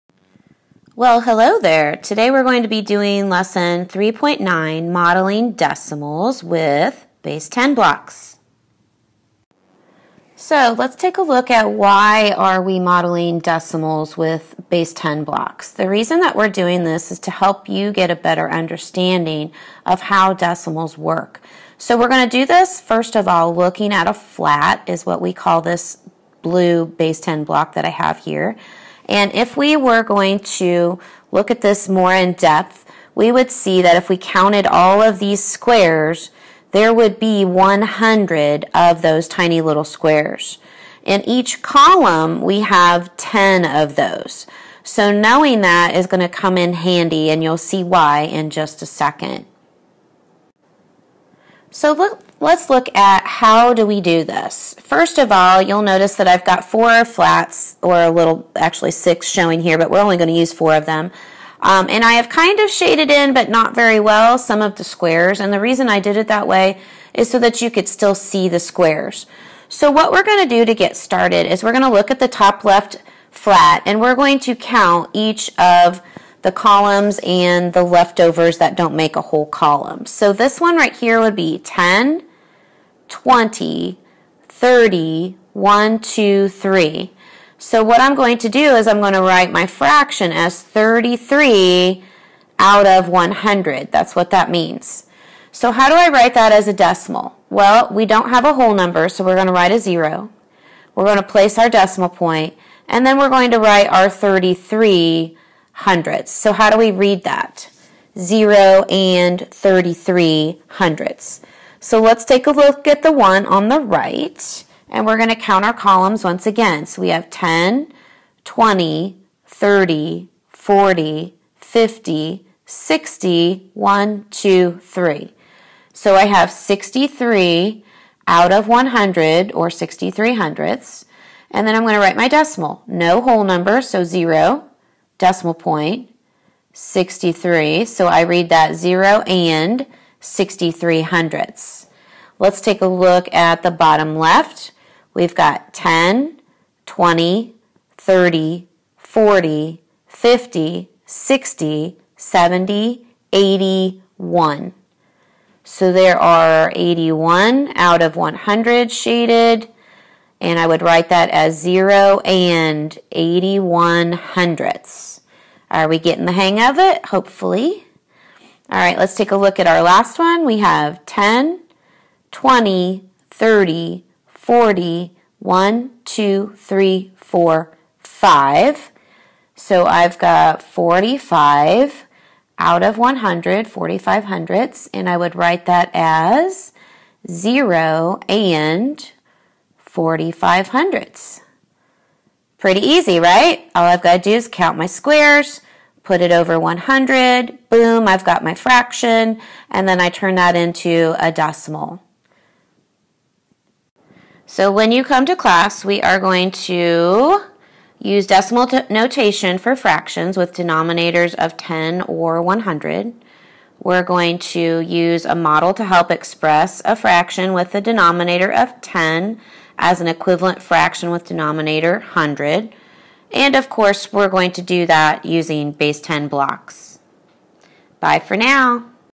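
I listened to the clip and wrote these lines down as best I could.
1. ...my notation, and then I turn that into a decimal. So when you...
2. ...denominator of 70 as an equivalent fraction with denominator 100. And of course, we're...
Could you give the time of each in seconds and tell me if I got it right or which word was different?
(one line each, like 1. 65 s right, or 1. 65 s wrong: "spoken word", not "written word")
1. 198 s wrong: "fraction", not "notation"
2. 217 s wrong: "10", not "70".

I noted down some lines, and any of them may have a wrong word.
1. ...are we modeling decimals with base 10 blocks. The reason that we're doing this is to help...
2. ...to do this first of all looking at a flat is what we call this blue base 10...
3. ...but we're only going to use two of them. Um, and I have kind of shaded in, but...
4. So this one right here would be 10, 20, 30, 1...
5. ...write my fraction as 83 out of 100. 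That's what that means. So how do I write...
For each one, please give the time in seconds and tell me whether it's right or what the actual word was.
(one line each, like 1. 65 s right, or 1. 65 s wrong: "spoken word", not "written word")
1. 12 s right
2. 22 s right
3. 59 s wrong: "four", not "two"
4. 80 s right
5. 89 s wrong: "33", not "83".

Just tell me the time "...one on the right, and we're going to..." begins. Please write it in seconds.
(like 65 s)
113 s.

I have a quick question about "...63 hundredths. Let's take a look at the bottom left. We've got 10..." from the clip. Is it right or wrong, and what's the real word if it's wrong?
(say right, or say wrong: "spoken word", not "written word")
right.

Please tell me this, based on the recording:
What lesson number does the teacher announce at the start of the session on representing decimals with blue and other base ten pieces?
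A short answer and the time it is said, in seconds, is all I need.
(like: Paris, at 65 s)
3.9, at 3 s.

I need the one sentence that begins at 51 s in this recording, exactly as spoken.
So look, let's look at how do we do this.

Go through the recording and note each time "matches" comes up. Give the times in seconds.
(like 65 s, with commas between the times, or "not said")
not said.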